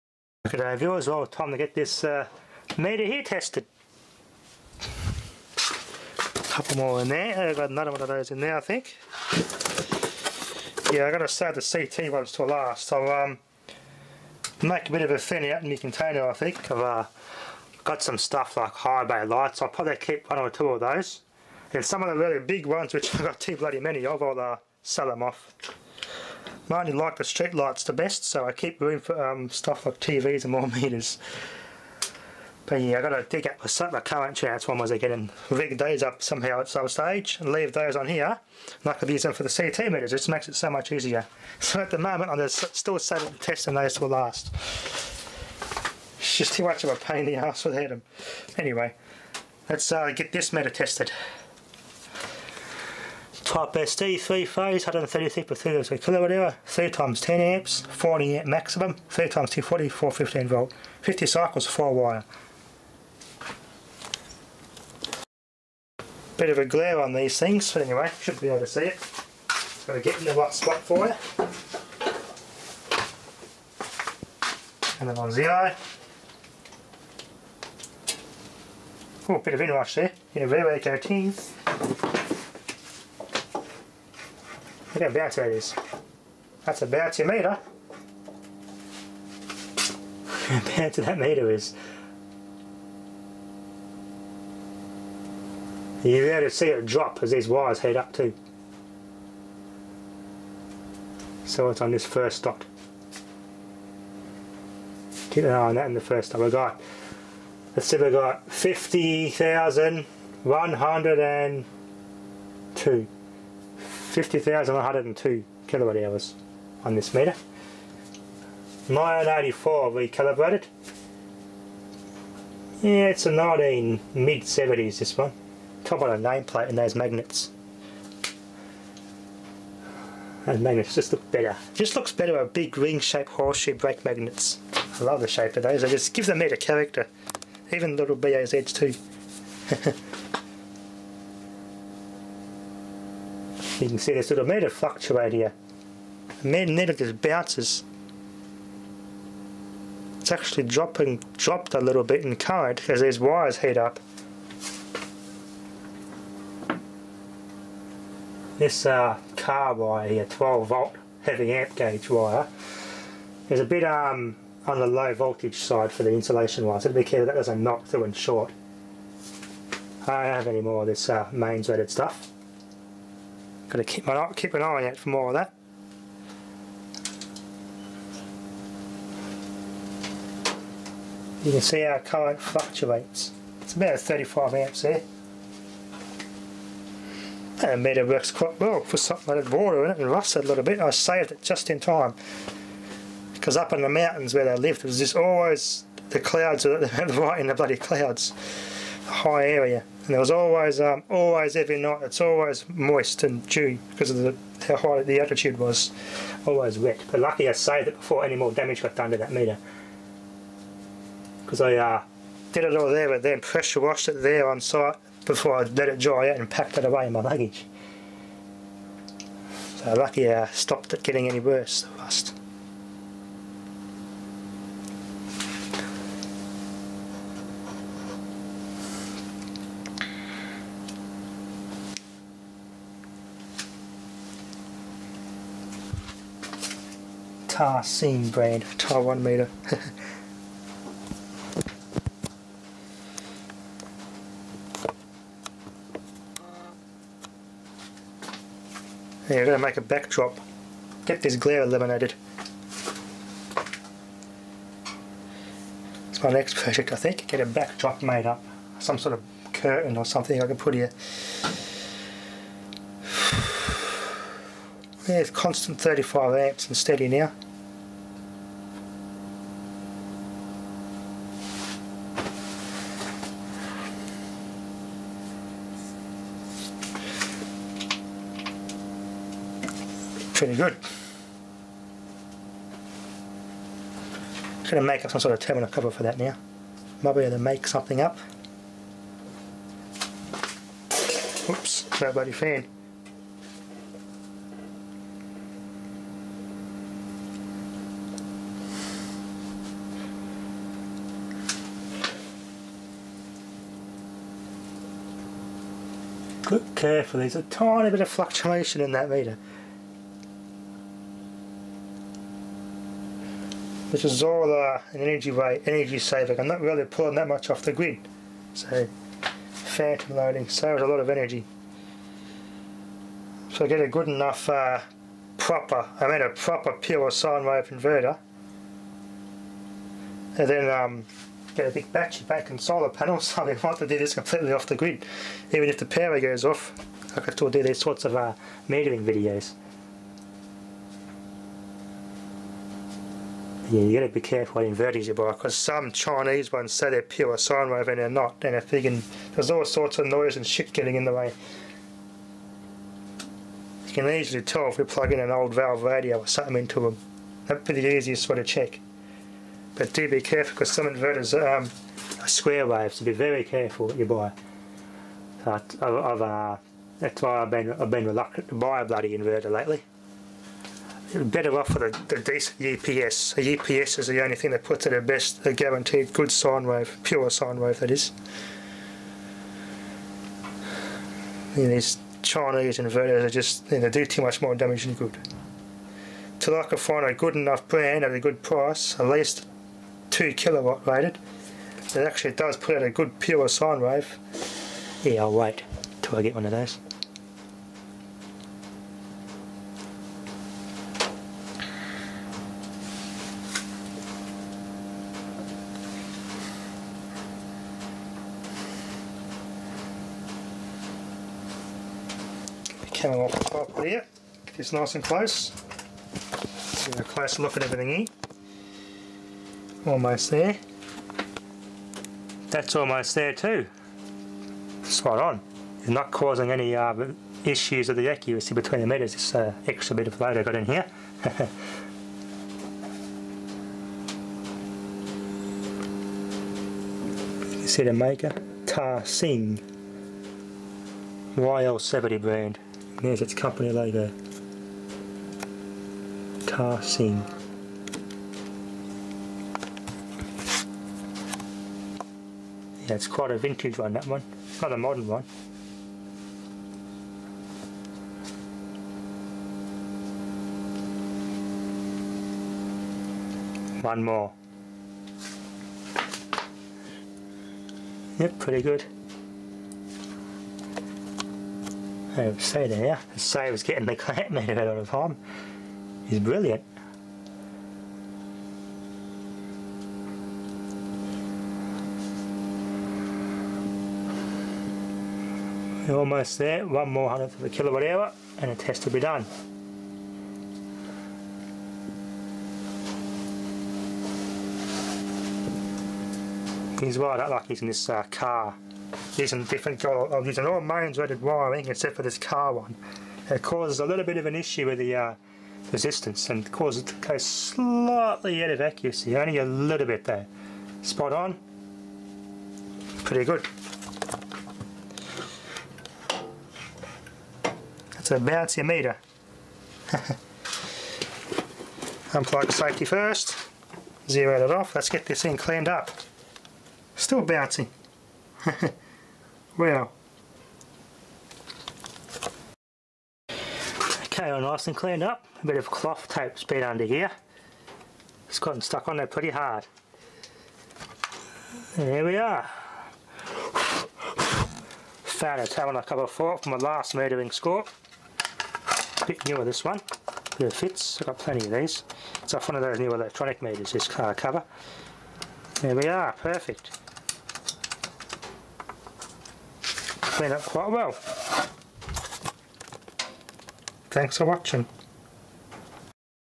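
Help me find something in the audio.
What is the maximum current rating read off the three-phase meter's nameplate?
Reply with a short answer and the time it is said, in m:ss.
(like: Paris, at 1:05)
40 amps, at 0:57.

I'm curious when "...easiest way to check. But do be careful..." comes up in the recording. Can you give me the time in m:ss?
5:57.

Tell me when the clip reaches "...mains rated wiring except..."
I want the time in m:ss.
8:20.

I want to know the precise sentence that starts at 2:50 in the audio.
I don't have any more of this uh, mains rated stuff.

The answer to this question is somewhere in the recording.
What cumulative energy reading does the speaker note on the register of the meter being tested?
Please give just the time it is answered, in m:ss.
1:54.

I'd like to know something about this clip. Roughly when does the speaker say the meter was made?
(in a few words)
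mid 70s.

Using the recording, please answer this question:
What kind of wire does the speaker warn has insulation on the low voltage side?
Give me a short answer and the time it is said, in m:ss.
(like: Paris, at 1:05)
car wire, at 2:39.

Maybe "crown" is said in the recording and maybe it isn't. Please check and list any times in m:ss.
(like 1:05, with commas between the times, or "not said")
not said.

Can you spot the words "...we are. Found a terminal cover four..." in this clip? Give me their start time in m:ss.
9:02.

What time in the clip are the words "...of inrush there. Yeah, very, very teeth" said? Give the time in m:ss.
1:19.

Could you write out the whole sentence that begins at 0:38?
And I could use them for the CT meters, it just makes it so much easier.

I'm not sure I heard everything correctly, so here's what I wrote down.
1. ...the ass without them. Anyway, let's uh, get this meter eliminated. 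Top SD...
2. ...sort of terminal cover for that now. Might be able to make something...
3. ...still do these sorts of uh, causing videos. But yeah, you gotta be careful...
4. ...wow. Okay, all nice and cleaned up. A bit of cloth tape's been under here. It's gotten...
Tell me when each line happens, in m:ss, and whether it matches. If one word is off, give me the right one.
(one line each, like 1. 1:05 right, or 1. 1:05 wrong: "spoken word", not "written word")
1. 0:47 wrong: "tested", not "eliminated"
2. 4:45 right
3. 5:37 wrong: "metering", not "causing"
4. 8:49 right.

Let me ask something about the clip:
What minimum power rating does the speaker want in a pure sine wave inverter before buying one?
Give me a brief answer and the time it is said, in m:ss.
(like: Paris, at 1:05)
2 kilowatts, at 6:30.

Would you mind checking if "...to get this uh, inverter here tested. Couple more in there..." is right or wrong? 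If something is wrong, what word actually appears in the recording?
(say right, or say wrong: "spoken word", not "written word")
wrong: "meter", not "inverter".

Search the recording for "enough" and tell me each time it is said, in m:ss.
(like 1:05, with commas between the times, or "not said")
5:24, 6:27.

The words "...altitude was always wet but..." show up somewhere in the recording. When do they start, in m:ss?
3:25.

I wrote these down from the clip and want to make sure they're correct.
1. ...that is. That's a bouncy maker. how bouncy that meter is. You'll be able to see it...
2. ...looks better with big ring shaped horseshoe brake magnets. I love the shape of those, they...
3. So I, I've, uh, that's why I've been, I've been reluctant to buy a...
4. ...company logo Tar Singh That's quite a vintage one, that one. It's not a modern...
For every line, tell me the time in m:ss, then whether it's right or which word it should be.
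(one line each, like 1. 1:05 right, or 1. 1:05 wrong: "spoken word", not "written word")
1. 1:25 wrong: "meter", not "maker"
2. 2:11 right
3. 6:05 right
4. 7:23 right.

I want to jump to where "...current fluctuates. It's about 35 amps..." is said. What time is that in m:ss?
3:01.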